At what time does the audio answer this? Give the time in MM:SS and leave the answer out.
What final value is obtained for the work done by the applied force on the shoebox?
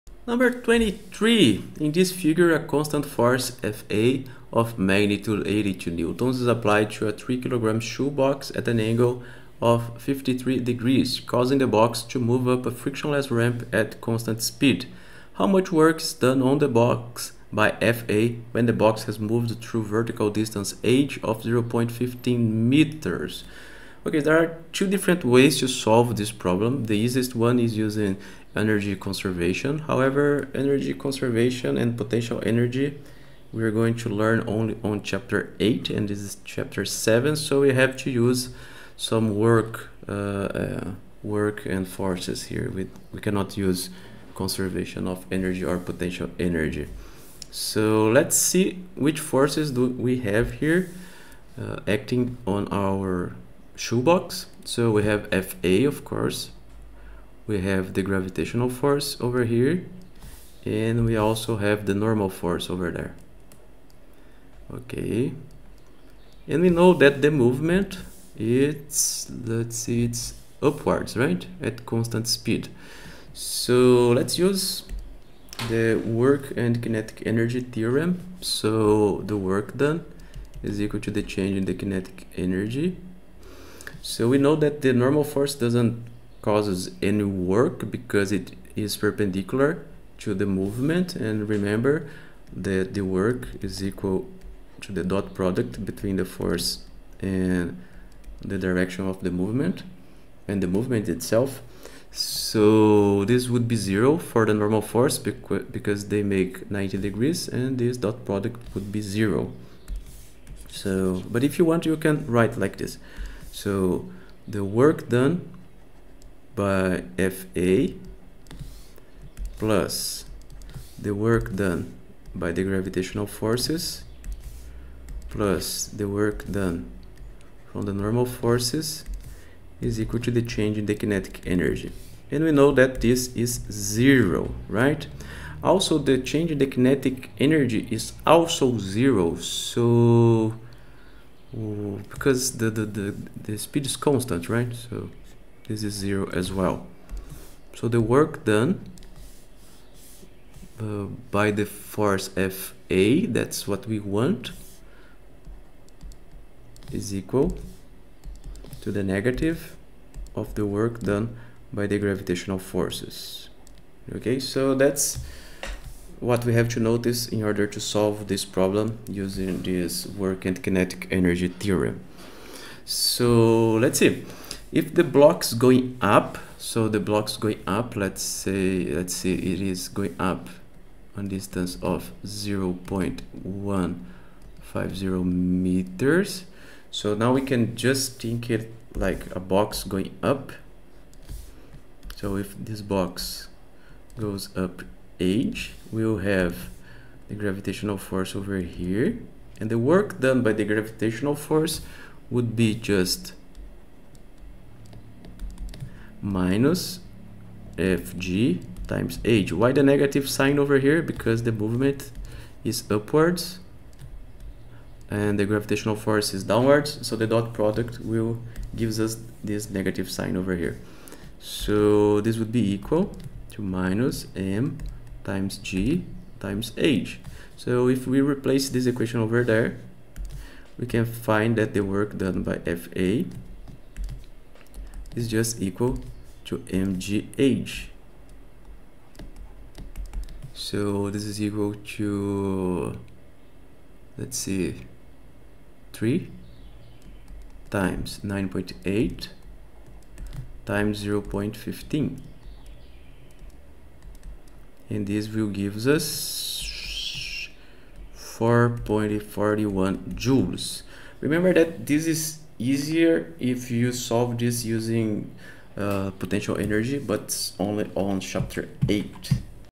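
04:18.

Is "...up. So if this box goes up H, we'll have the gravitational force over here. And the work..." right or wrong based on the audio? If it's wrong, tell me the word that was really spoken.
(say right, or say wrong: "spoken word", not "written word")
right.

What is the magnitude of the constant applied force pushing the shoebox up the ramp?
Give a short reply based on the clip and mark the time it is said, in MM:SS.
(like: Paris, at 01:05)
82 newtons, at 00:05.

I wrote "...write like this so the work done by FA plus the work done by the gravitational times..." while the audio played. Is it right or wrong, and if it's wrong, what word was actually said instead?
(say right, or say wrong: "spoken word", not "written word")
wrong: "forces", not "times".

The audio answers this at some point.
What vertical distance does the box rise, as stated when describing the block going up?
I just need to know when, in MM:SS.
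03:02.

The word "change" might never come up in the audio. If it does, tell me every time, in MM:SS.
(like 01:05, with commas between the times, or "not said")
01:21, 02:10, 02:16.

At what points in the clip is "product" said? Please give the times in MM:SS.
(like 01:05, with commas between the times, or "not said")
01:35, 01:48, 03:37.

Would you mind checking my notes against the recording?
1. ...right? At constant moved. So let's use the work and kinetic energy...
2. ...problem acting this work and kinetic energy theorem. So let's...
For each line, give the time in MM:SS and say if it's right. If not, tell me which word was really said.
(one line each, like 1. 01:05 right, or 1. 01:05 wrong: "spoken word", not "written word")
1. 01:11 wrong: "speed", not "moved"
2. 02:48 wrong: "using", not "acting".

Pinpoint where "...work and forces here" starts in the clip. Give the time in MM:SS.
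00:41.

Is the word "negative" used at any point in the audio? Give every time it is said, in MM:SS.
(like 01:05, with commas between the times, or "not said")
02:39, 03:29, 03:39.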